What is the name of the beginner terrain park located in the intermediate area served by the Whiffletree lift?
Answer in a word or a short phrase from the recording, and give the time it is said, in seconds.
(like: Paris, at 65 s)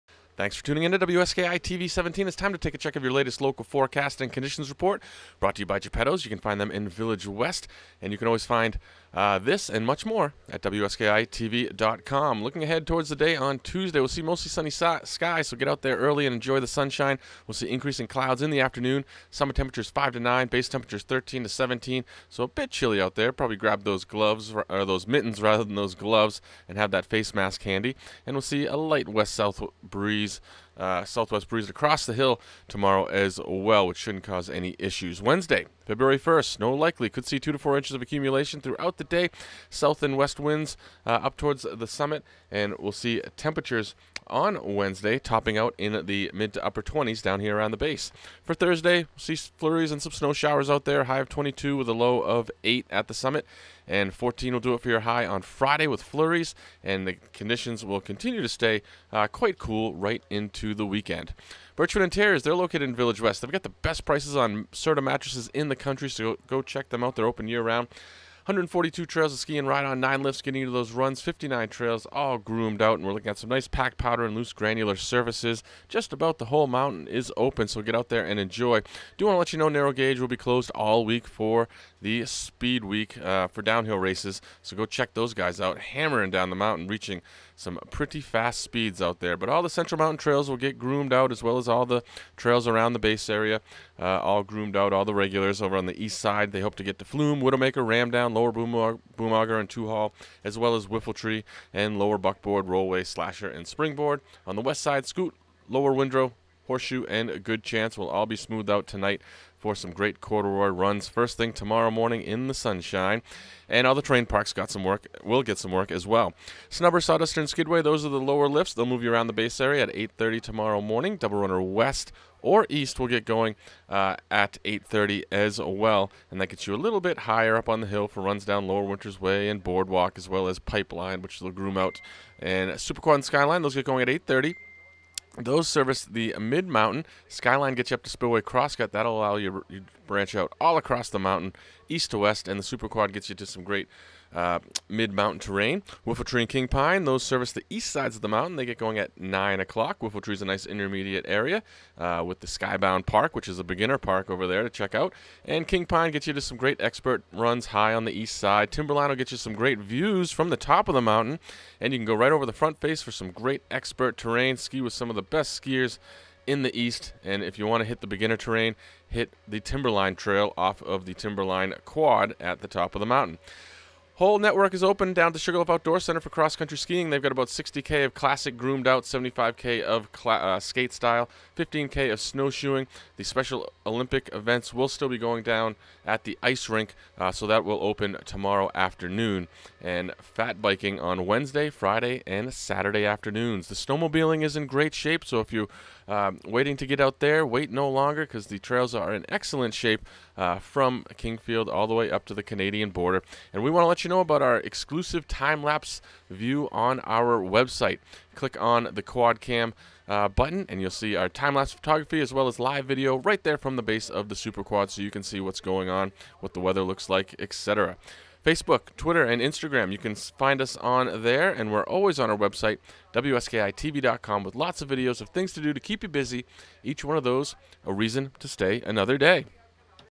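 Skybound Park, at 152 s.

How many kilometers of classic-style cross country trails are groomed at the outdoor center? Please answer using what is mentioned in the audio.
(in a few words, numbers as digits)
60.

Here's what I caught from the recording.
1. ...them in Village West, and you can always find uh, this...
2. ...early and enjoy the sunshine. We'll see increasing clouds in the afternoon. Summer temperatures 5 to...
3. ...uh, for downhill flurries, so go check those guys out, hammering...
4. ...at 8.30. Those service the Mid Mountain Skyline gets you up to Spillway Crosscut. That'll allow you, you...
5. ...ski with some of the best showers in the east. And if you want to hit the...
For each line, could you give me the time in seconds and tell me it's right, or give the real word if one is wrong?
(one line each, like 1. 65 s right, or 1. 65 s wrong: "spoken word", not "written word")
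1. 6 s right
2. 15 s right
3. 83 s wrong: "races", not "flurries"
4. 134 s right
5. 164 s wrong: "skiers", not "showers".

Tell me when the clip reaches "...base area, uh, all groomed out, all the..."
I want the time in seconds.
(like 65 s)
92 s.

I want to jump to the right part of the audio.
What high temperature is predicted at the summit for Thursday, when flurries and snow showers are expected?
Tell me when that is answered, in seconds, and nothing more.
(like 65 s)
51 s.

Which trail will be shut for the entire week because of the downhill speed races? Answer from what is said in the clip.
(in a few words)
Narrow Gauge.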